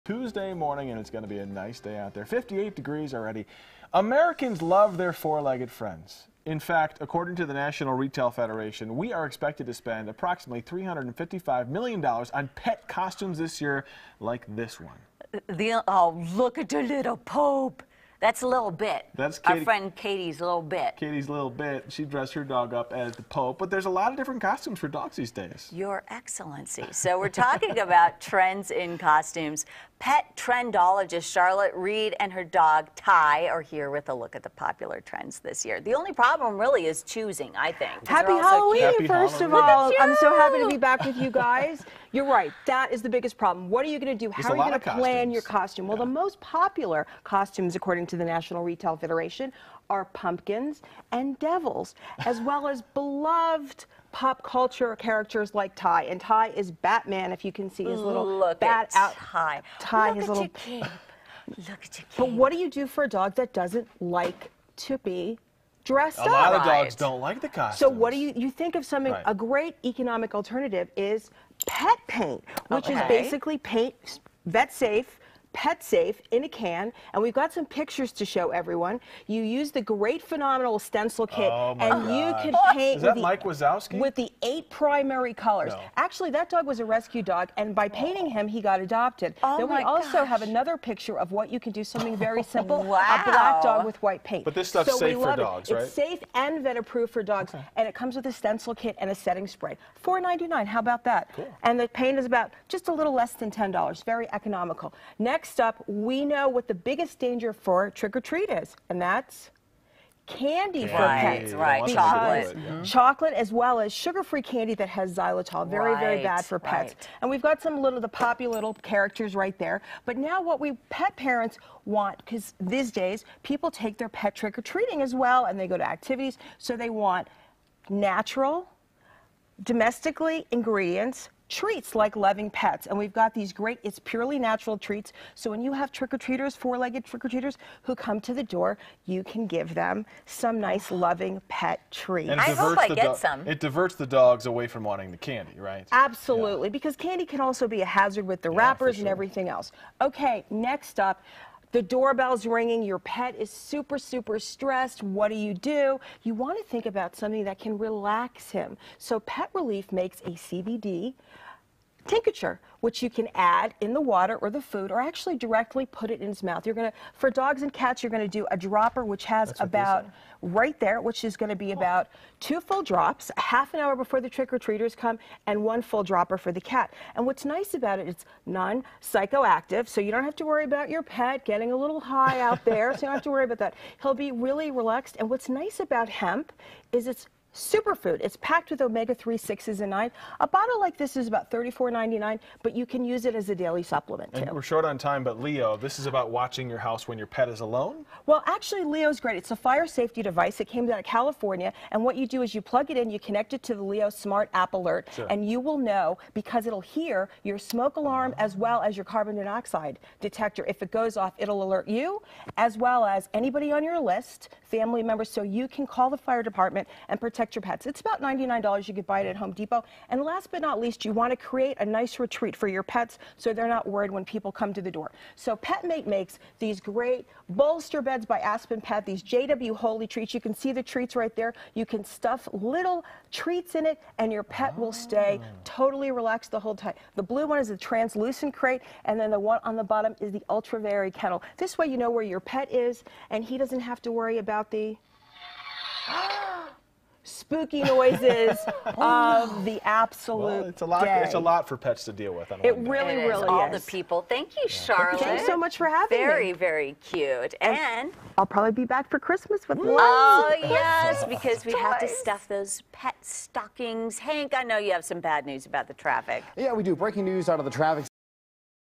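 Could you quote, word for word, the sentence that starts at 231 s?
You can stuff little treats in it and your pet oh.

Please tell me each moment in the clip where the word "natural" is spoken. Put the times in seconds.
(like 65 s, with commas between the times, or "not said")
127 s, 134 s.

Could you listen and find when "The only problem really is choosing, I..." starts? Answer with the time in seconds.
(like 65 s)
35 s.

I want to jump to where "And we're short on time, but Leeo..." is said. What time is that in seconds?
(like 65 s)
194 s.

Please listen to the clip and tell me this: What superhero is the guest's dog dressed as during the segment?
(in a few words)
Batman.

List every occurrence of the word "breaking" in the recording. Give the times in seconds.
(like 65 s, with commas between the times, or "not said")
266 s.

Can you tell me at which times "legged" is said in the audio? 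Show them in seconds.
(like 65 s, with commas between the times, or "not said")
5 s, 136 s.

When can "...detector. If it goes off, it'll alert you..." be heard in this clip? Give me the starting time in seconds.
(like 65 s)
210 s.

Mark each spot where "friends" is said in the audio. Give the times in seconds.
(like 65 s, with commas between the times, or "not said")
5 s, 19 s.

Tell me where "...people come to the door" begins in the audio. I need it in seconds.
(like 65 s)
224 s.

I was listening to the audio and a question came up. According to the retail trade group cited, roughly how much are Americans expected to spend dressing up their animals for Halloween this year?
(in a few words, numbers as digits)
$355 million.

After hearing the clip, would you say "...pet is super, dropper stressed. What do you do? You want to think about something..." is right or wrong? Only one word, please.
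wrong.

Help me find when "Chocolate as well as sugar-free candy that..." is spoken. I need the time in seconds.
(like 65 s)
112 s.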